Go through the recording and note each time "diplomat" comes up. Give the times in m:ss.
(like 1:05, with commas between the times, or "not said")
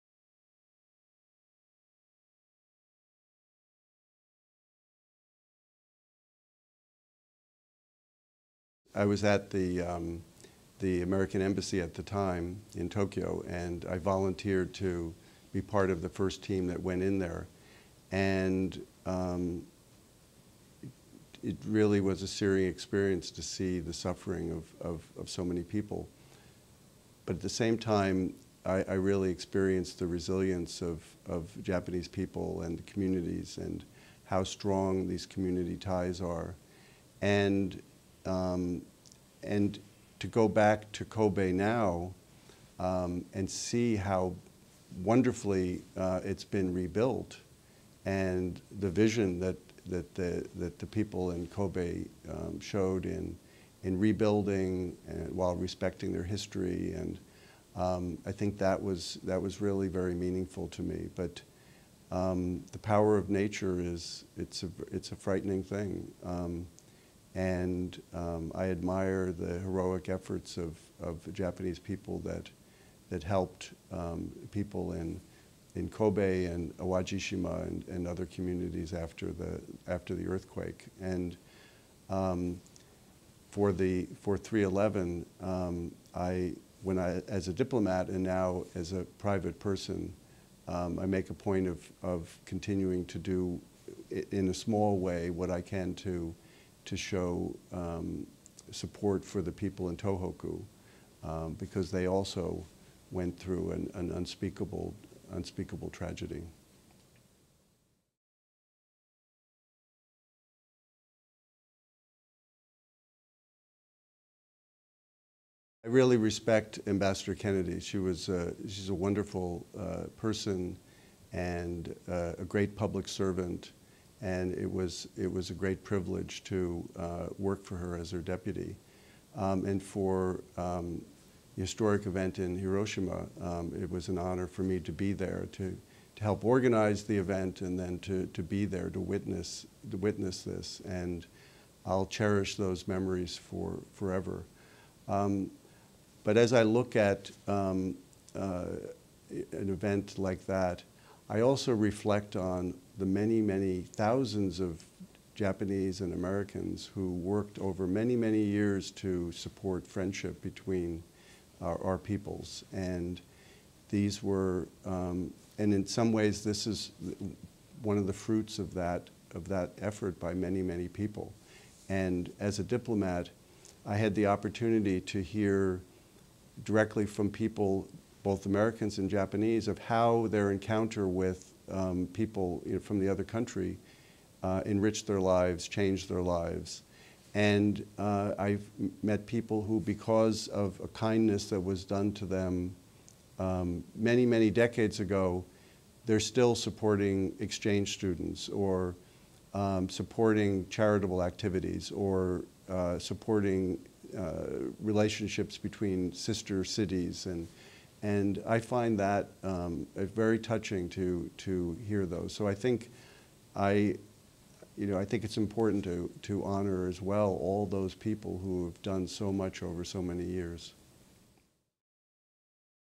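1:27, 2:52.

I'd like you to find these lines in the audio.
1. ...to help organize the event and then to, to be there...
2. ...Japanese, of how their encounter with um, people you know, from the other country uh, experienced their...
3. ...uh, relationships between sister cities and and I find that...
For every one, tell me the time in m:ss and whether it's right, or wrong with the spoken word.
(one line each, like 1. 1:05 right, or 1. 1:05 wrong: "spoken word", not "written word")
1. 2:16 right
2. 2:59 wrong: "enriched", not "experienced"
3. 3:24 right.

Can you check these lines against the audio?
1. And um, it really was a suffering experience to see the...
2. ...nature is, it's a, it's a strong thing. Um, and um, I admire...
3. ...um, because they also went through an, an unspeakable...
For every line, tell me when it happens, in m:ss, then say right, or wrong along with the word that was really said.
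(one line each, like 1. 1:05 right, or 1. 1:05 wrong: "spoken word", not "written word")
1. 0:18 wrong: "searing", not "suffering"
2. 1:03 wrong: "frightening", not "strong"
3. 1:41 right.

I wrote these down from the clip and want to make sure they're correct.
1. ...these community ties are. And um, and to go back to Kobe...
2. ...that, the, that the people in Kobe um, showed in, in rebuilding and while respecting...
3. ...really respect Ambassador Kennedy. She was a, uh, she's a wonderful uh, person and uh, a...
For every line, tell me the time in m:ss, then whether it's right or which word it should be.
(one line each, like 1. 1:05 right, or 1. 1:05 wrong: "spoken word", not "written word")
1. 0:35 right
2. 0:49 right
3. 1:55 right.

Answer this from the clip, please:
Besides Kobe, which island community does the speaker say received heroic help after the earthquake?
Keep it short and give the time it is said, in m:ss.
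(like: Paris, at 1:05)
Awajishima, at 1:16.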